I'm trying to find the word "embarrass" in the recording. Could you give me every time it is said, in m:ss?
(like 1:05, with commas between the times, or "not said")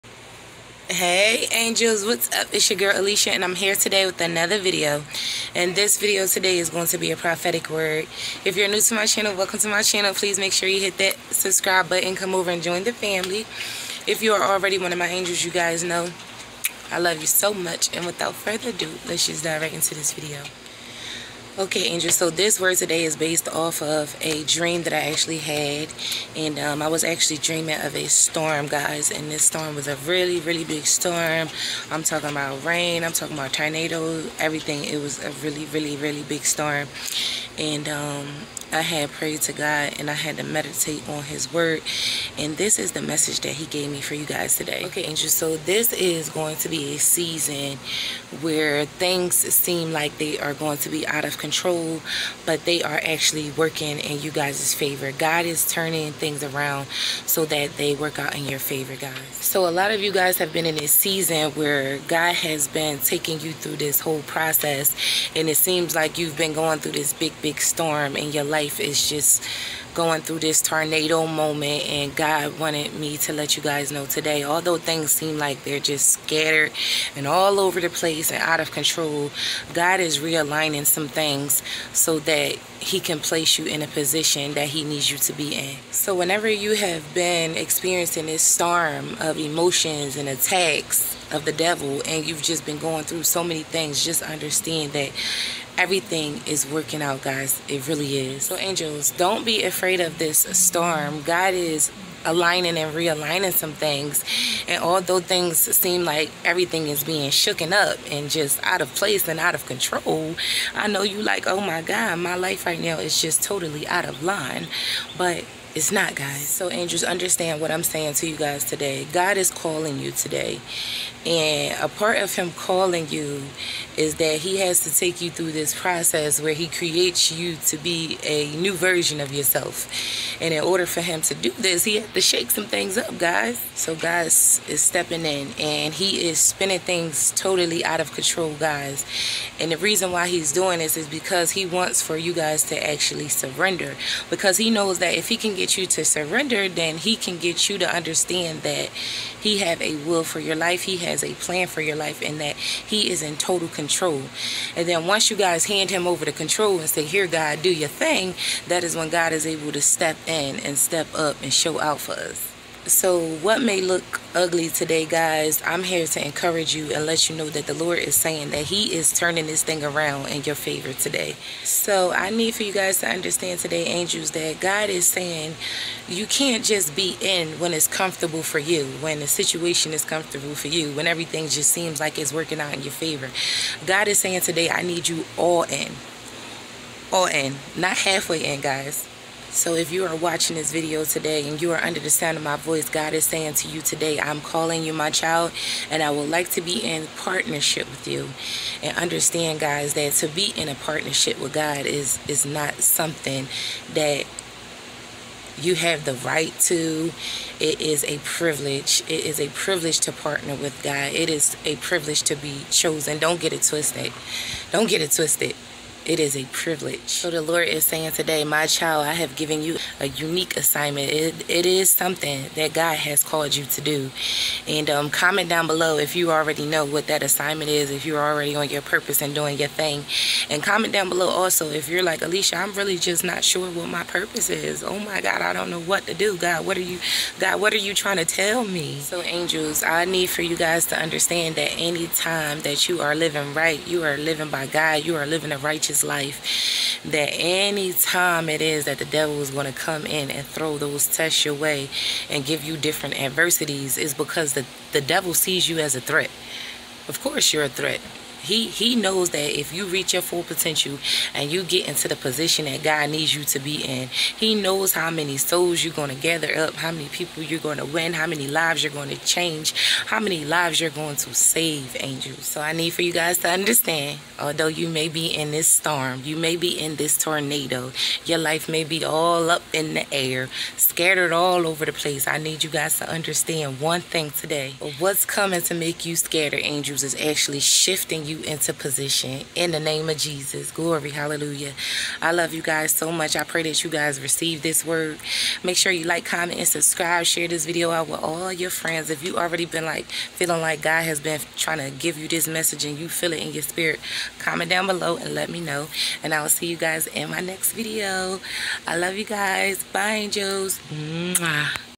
not said.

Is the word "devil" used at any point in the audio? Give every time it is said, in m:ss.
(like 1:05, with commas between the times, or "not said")
1:31, 4:09, 4:15.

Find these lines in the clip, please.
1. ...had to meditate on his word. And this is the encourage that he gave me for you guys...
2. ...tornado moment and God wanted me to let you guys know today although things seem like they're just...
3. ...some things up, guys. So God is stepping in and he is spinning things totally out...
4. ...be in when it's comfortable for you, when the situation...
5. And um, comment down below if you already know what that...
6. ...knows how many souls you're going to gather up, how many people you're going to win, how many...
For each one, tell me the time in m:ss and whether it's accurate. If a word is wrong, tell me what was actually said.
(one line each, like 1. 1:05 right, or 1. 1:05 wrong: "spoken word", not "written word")
1. 0:40 wrong: "message", not "encourage"
2. 1:10 right
3. 2:12 right
4. 2:56 right
5. 3:44 right
6. 4:24 right.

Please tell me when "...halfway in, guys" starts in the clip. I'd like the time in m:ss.
3:07.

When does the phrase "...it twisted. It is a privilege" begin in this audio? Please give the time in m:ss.
3:35.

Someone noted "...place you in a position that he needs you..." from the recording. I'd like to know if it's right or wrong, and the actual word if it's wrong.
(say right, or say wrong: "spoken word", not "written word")
right.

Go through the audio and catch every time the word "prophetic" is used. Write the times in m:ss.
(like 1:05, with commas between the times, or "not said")
0:07.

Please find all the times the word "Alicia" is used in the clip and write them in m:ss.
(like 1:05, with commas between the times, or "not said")
0:02, 3:52.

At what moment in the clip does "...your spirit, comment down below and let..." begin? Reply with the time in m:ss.
5:03.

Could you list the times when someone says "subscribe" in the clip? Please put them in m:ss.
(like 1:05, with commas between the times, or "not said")
0:11, 4:56.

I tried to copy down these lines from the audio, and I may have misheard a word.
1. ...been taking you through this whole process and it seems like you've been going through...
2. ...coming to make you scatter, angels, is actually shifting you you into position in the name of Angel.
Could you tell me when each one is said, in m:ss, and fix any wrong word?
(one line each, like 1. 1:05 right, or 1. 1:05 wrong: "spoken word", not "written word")
1. 1:02 right
2. 4:45 wrong: "Jesus", not "Angel".